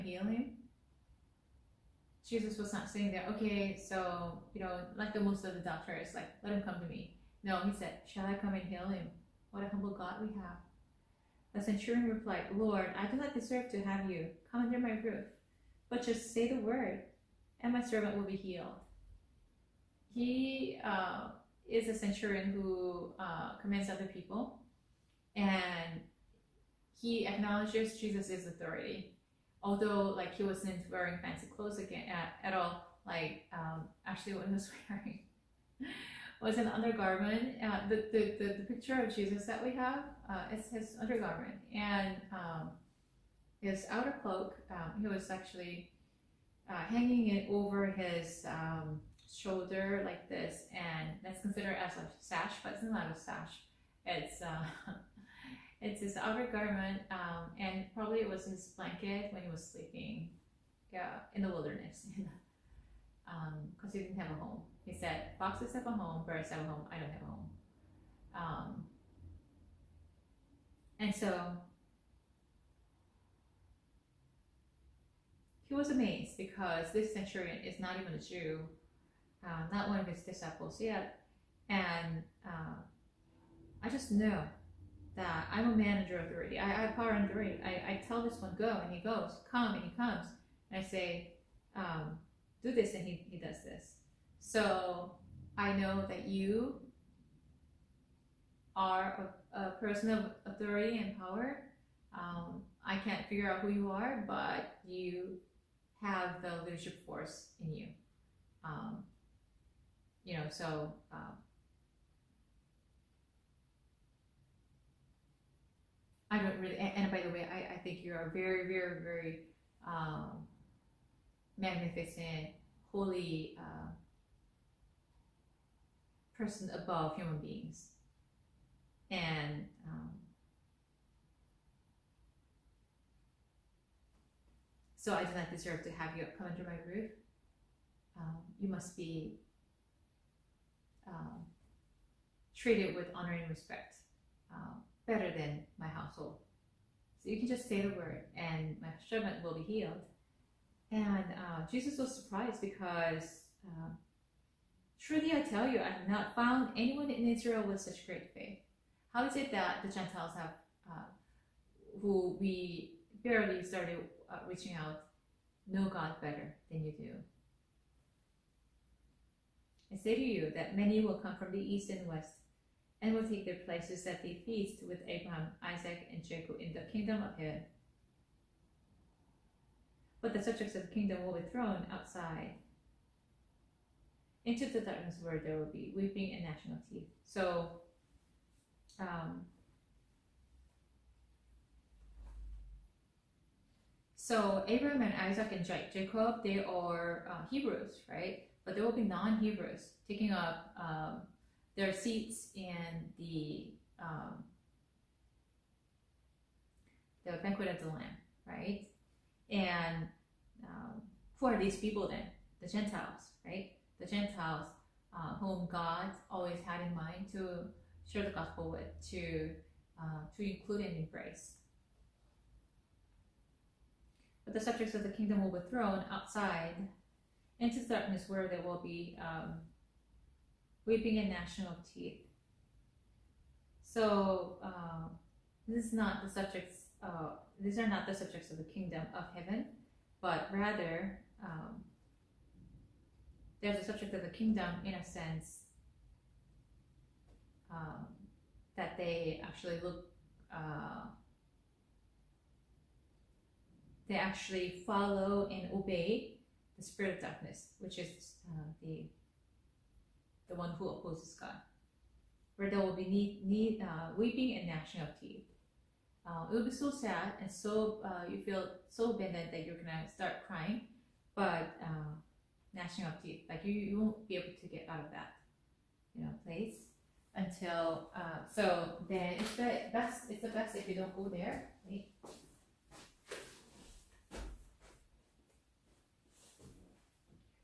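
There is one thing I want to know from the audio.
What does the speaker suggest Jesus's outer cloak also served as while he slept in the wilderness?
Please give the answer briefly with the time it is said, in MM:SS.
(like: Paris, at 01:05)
his blanket, at 00:58.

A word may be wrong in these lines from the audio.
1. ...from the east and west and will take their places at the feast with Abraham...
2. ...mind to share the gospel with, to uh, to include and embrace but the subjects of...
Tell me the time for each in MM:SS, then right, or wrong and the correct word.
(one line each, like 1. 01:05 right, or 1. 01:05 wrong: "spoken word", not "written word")
1. 02:51 right
2. 03:36 right.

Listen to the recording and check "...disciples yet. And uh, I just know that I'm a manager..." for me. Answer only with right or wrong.
right.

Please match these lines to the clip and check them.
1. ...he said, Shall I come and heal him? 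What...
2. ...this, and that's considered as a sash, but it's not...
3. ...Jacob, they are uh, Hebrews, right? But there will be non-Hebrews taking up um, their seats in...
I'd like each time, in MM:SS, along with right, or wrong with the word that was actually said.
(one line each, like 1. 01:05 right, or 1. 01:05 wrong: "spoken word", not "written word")
1. 00:07 right
2. 00:50 right
3. 03:15 right.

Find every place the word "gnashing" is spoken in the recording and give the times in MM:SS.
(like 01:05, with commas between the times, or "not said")
03:06, 03:51, 04:24, 04:32.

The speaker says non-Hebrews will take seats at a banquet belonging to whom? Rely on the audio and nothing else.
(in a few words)
the Lamb.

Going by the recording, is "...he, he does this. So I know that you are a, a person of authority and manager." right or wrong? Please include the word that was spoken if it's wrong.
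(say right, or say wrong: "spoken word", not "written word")
wrong: "power", not "manager".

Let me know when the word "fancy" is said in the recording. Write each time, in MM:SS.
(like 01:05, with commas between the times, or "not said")
00:31.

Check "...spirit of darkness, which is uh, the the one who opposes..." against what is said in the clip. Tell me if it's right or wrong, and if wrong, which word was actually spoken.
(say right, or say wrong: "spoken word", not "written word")
right.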